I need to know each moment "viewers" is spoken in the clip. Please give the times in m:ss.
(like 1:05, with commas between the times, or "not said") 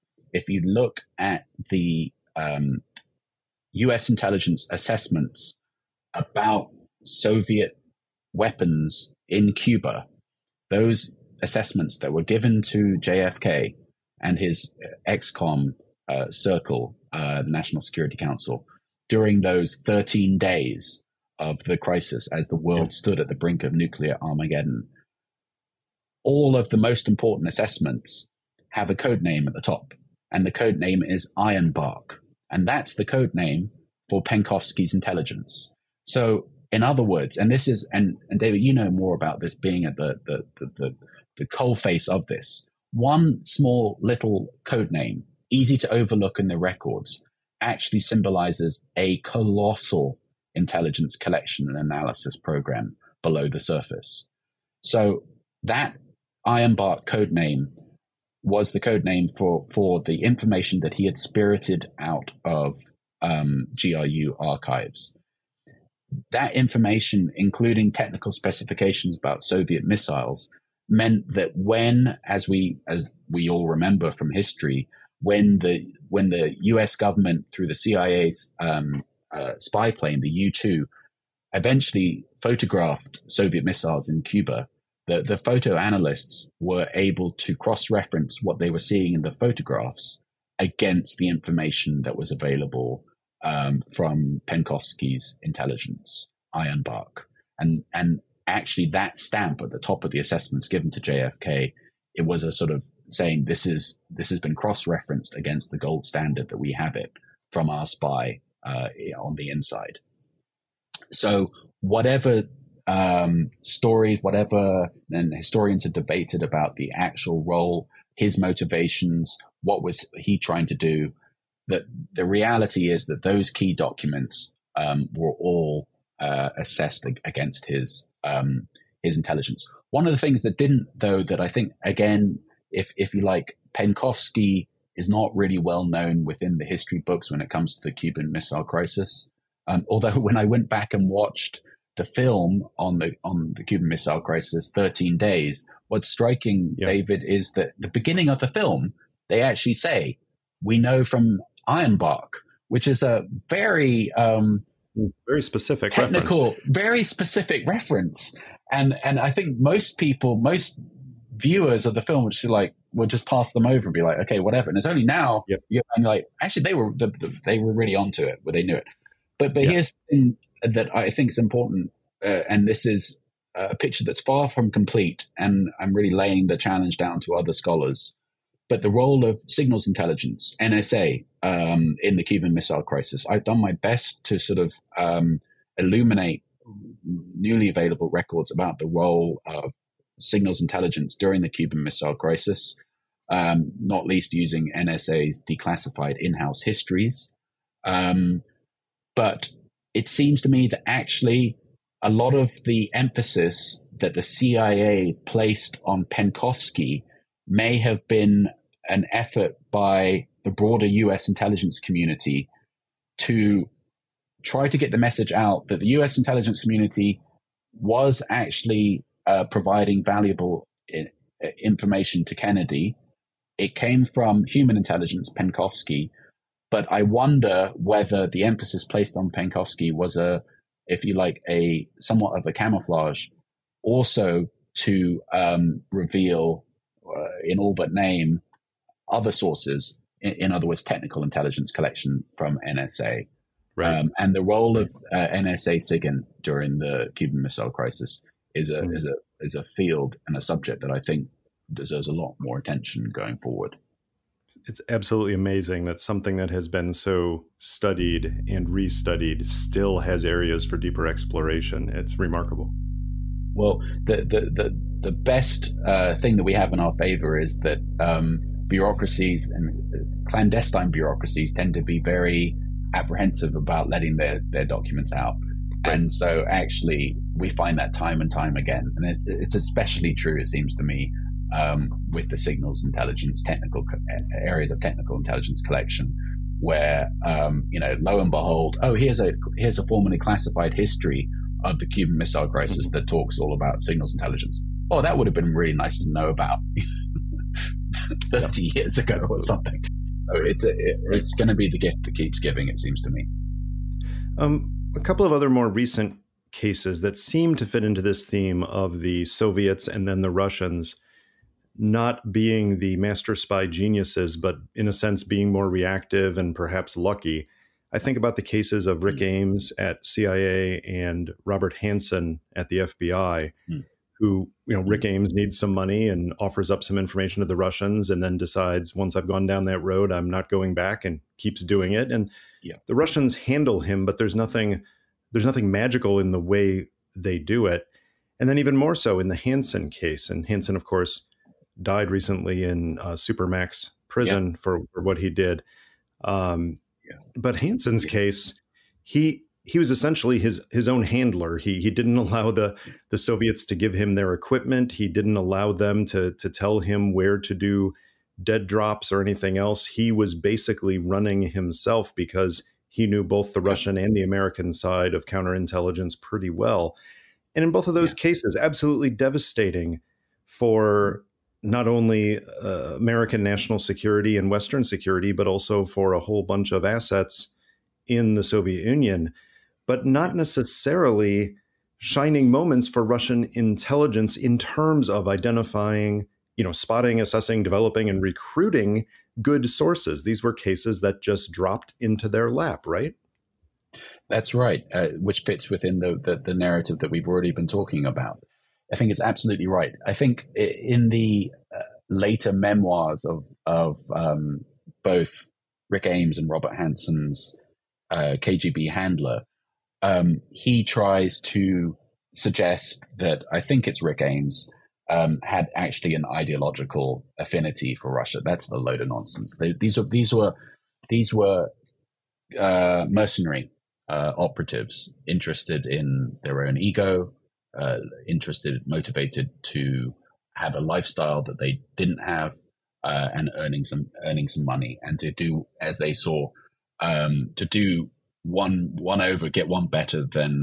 2:41.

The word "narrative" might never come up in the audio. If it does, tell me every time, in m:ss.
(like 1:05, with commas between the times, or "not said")
6:36.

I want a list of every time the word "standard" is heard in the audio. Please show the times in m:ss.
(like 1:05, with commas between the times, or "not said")
1:46.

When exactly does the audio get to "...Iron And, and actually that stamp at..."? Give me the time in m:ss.
1:36.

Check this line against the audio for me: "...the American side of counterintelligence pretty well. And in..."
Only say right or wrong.
right.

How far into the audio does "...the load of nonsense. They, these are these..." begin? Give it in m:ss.
6:58.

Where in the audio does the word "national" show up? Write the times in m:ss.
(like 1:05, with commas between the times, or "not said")
0:17, 6:13.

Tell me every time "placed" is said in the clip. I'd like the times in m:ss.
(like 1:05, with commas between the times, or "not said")
3:25, 3:48.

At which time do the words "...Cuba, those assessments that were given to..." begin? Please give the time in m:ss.
0:09.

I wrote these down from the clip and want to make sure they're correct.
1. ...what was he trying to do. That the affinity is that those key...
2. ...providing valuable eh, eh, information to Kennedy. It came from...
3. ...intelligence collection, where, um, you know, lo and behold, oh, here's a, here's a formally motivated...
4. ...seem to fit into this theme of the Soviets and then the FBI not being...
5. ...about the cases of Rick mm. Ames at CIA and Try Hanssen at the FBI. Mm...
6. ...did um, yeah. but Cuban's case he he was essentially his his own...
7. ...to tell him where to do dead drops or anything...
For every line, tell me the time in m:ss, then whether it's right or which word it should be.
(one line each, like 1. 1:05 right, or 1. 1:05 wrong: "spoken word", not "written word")
1. 1:59 wrong: "reality", not "affinity"
2. 3:39 right
3. 4:45 wrong: "classified", not "motivated"
4. 5:07 wrong: "Russians", not "FBI"
5. 5:18 wrong: "Robert", not "Try"
6. 5:45 wrong: "Hanssen", not "Cuban"
7. 5:56 right.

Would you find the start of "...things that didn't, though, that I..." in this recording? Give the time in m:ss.
2:10.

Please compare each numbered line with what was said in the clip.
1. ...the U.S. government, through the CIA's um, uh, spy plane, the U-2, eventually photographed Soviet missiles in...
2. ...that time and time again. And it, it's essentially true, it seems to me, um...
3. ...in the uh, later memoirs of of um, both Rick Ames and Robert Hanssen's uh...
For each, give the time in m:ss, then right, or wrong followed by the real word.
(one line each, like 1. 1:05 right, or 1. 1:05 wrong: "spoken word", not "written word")
1. 1:16 right
2. 4:37 wrong: "especially", not "essentially"
3. 6:40 right.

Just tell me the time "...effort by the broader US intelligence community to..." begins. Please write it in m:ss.
3:29.